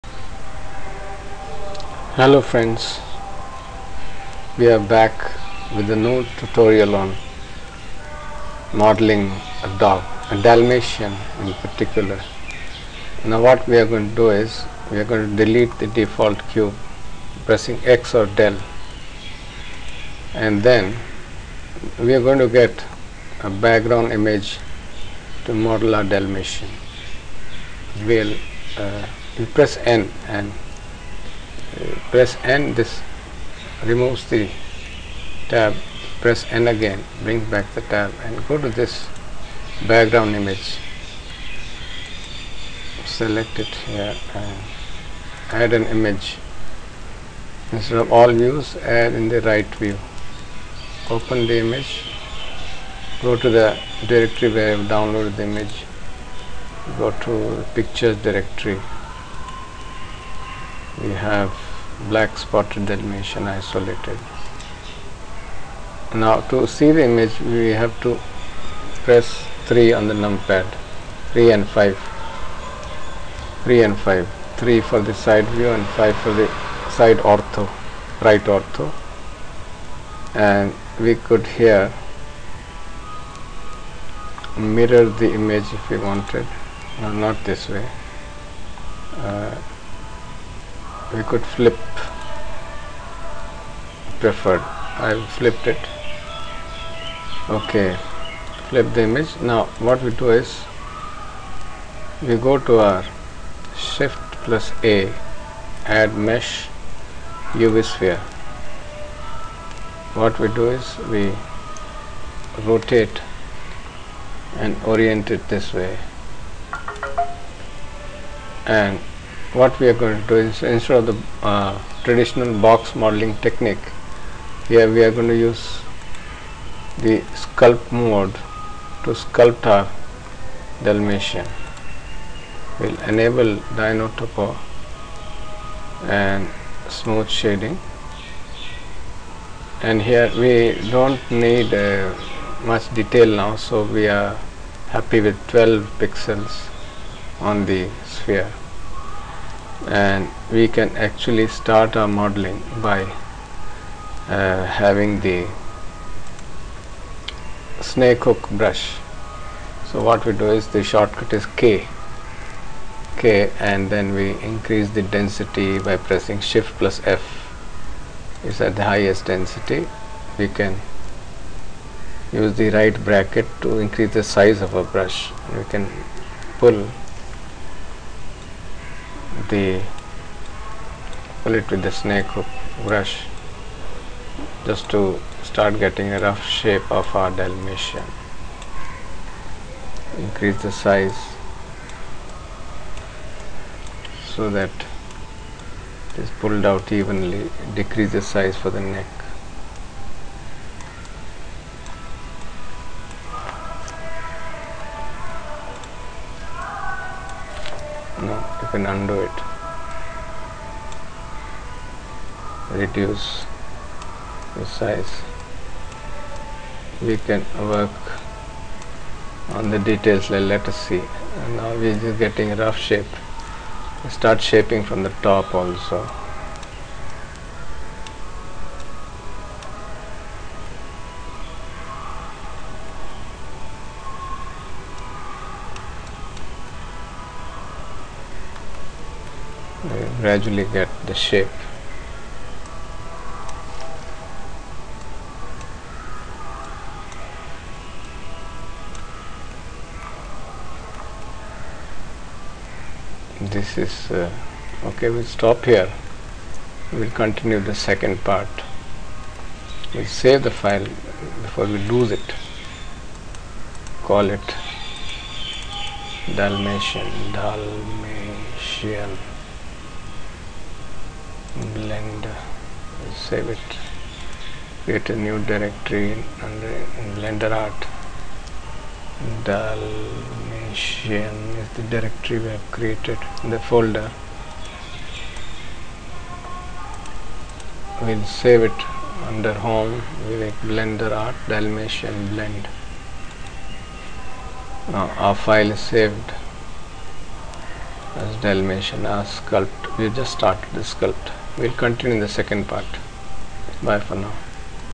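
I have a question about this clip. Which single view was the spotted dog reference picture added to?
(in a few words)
right view.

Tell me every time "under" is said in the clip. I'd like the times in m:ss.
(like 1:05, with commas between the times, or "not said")
4:36, 4:49.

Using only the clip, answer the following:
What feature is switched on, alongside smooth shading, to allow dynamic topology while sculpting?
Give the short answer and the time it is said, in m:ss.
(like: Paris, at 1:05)
dyno topo, at 2:13.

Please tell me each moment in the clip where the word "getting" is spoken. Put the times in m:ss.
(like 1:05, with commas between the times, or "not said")
3:05, 3:42.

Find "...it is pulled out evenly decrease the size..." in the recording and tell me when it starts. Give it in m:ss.
3:14.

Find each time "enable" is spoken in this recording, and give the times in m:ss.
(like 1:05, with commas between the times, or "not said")
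2:13.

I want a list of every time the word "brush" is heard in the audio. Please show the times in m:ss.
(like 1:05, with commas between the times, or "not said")
2:38, 2:54, 3:02.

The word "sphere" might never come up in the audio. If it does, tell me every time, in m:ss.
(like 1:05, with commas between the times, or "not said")
1:47, 2:28.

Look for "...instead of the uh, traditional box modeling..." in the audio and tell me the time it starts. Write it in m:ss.
2:00.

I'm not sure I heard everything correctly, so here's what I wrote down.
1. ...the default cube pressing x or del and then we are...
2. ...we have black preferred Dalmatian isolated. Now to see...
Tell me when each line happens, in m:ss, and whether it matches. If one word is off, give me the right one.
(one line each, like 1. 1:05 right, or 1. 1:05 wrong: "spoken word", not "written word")
1. 0:15 right
2. 1:01 wrong: "spotted", not "preferred".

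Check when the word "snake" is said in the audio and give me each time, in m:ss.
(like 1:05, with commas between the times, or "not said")
2:37, 3:01.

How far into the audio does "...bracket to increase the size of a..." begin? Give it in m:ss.
2:53.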